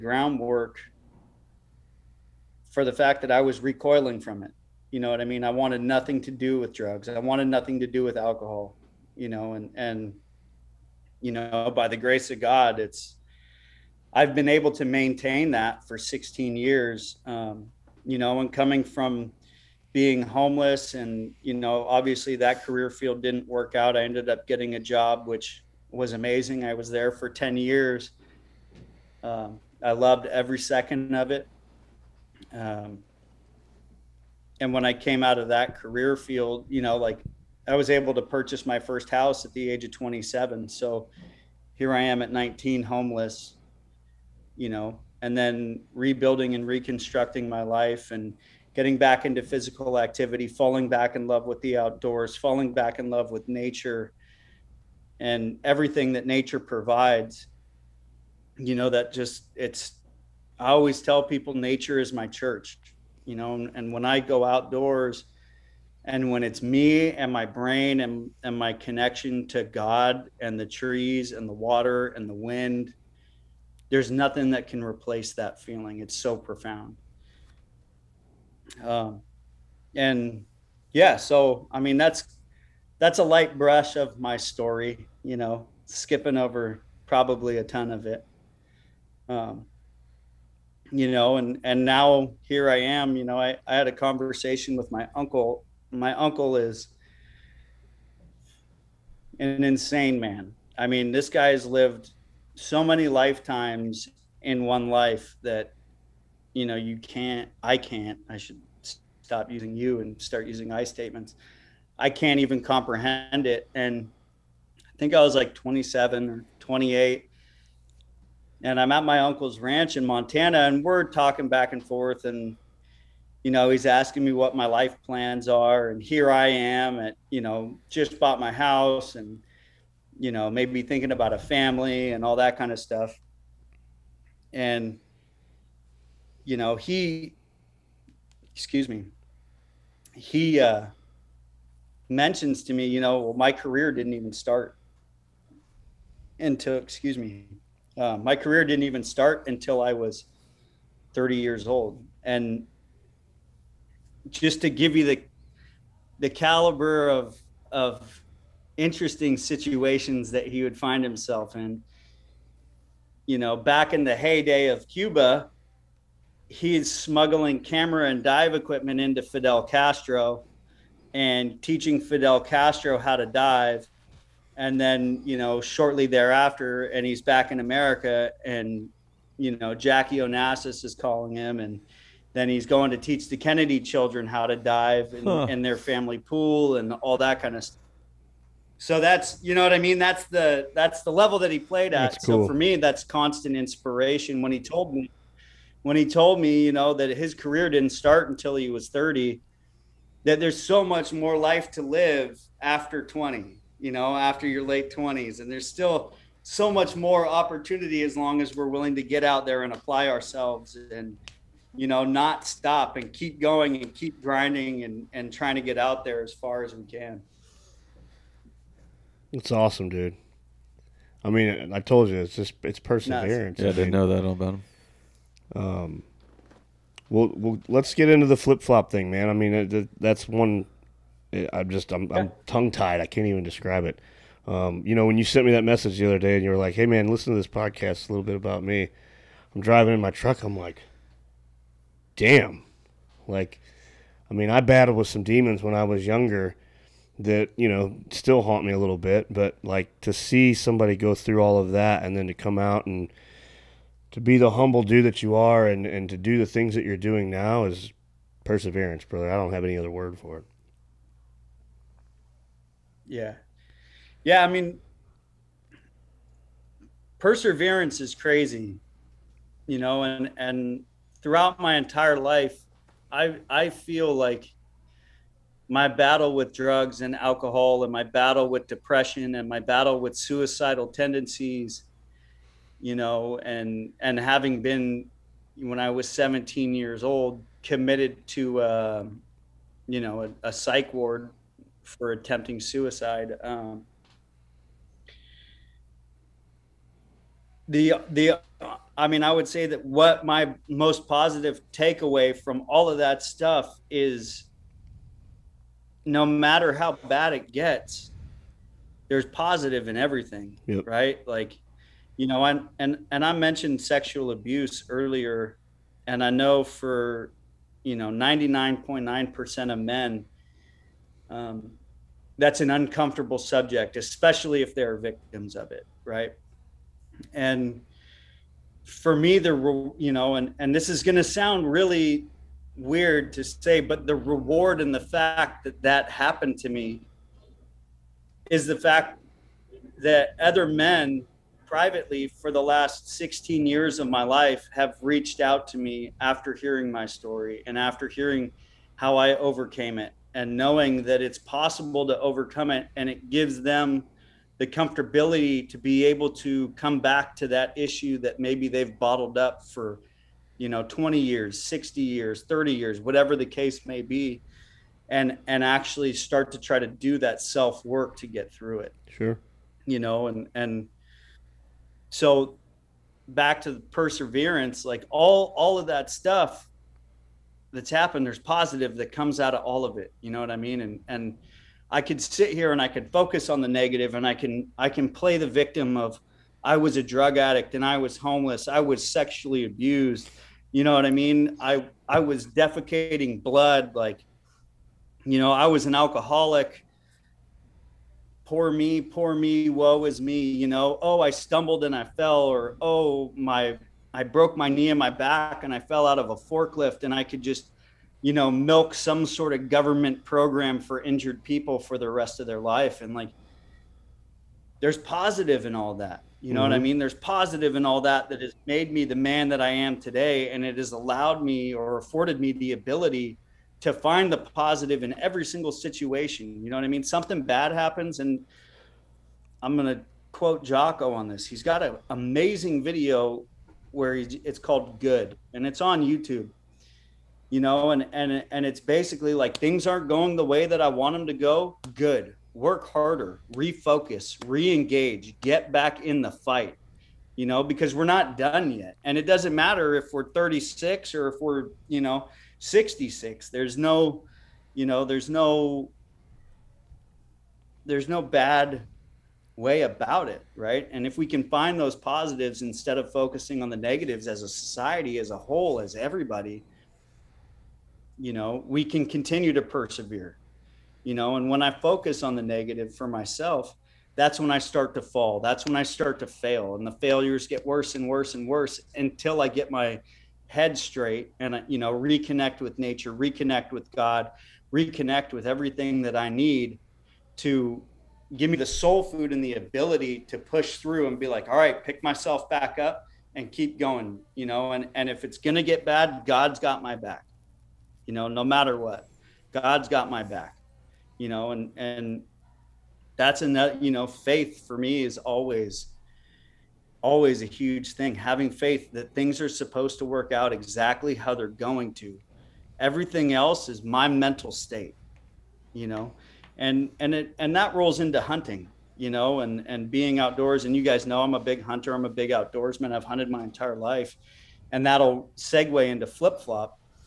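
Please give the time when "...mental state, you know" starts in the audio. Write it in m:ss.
8:34.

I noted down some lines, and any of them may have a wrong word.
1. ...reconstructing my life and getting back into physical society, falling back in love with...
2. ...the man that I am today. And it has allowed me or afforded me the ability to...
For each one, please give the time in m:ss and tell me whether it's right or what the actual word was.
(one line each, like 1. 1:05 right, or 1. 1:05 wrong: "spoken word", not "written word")
1. 0:46 wrong: "activity", not "society"
2. 6:59 right.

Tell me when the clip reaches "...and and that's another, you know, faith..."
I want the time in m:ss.
8:21.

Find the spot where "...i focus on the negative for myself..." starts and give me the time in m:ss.
7:51.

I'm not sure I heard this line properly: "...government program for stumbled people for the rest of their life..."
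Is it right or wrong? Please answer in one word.
wrong.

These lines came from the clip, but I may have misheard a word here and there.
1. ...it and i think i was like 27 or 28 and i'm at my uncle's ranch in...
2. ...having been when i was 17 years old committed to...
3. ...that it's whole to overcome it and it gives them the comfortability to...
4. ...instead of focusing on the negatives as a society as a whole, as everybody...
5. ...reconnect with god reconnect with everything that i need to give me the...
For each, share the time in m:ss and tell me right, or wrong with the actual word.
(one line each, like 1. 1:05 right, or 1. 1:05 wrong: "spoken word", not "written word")
1. 1:53 right
2. 4:44 right
3. 5:51 wrong: "possible", not "whole"
4. 7:42 right
5. 8:03 right.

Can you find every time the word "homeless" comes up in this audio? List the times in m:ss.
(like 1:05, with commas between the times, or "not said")
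0:20, 0:42, 6:28.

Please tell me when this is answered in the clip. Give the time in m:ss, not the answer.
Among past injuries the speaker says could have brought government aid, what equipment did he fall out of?
6:46.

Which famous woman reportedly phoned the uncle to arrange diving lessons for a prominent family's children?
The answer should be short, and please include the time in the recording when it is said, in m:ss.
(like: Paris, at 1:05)
Jackie Onassis, at 2:59.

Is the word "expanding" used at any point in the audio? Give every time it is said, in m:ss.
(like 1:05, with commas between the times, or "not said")
not said.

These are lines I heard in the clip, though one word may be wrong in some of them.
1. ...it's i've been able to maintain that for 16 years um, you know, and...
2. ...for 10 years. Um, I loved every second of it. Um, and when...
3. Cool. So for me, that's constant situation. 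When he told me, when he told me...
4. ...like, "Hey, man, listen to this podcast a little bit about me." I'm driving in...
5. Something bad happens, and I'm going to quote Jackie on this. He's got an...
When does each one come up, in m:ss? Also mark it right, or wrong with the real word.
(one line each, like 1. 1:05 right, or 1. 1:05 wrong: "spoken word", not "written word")
1. 0:12 right
2. 0:27 right
3. 3:12 wrong: "inspiration", not "situation"
4. 3:56 right
5. 7:07 wrong: "Jocko", not "Jackie".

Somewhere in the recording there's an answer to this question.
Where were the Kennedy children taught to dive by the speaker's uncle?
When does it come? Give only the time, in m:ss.
3:05.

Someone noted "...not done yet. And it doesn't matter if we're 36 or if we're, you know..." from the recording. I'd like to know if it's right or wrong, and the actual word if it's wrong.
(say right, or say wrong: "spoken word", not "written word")
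right.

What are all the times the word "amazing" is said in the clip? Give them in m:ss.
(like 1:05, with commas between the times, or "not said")
0:26, 7:12.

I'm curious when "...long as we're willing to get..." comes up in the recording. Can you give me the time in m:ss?
3:28.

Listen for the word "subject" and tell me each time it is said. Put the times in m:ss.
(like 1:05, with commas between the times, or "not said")
5:23.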